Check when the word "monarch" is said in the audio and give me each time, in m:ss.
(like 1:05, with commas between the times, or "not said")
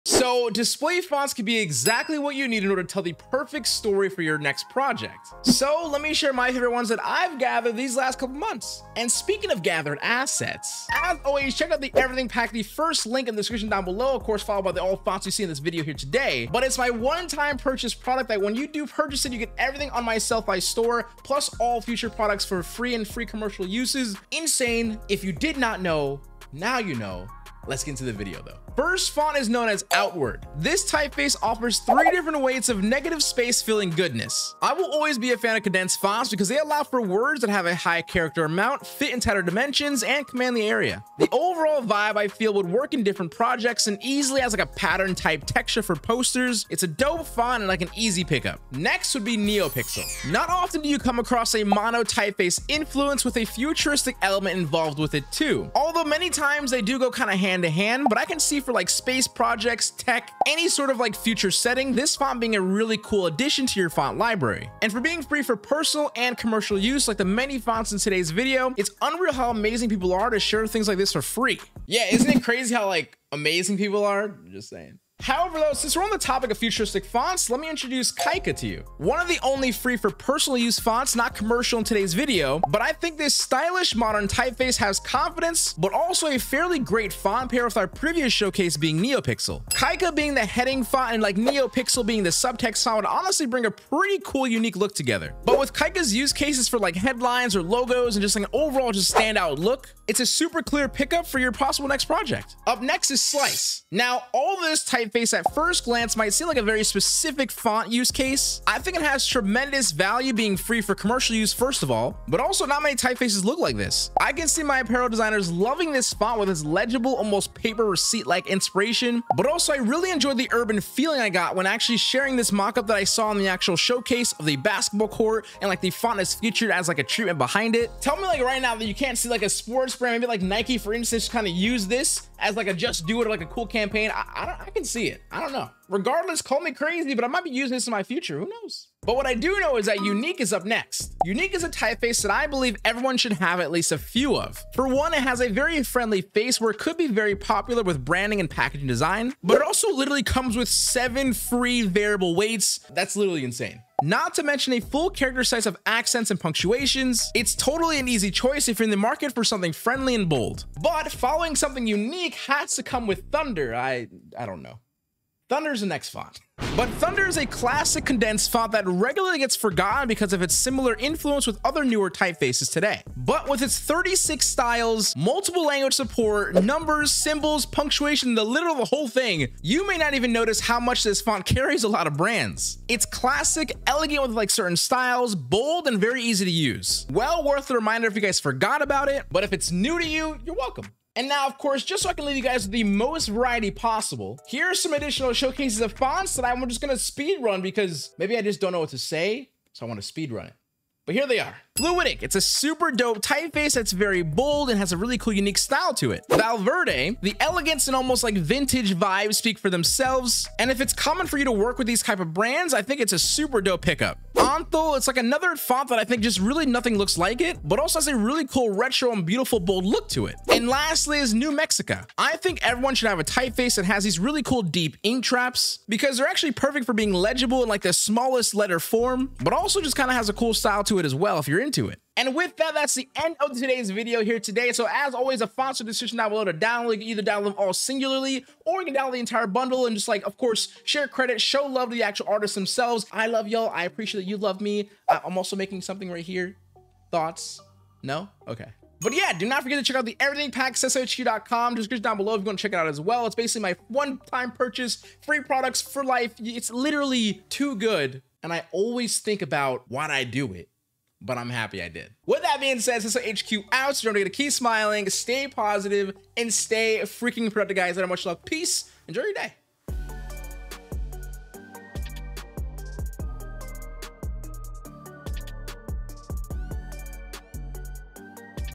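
not said.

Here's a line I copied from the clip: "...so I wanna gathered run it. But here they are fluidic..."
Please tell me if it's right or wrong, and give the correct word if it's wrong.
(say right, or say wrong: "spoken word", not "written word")
wrong: "speed", not "gathered".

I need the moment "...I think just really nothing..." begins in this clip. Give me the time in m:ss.
3:35.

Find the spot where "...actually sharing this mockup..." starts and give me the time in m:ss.
2:01.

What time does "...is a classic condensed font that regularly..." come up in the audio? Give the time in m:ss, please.
2:47.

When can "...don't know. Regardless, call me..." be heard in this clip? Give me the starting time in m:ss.
2:15.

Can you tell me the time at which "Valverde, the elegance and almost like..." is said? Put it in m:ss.
3:26.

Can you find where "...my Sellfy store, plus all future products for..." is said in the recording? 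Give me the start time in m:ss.
0:20.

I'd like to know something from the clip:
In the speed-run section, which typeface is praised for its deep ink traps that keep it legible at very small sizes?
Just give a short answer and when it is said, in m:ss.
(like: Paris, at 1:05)
New Mexico, at 3:41.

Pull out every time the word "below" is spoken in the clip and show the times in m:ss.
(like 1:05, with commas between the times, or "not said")
0:13, 3:56, 4:12.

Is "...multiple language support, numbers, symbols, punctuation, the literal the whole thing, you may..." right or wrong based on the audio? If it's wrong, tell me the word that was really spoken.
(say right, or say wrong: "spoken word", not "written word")
right.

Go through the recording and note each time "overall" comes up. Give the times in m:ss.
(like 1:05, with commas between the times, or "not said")
0:41, 1:38.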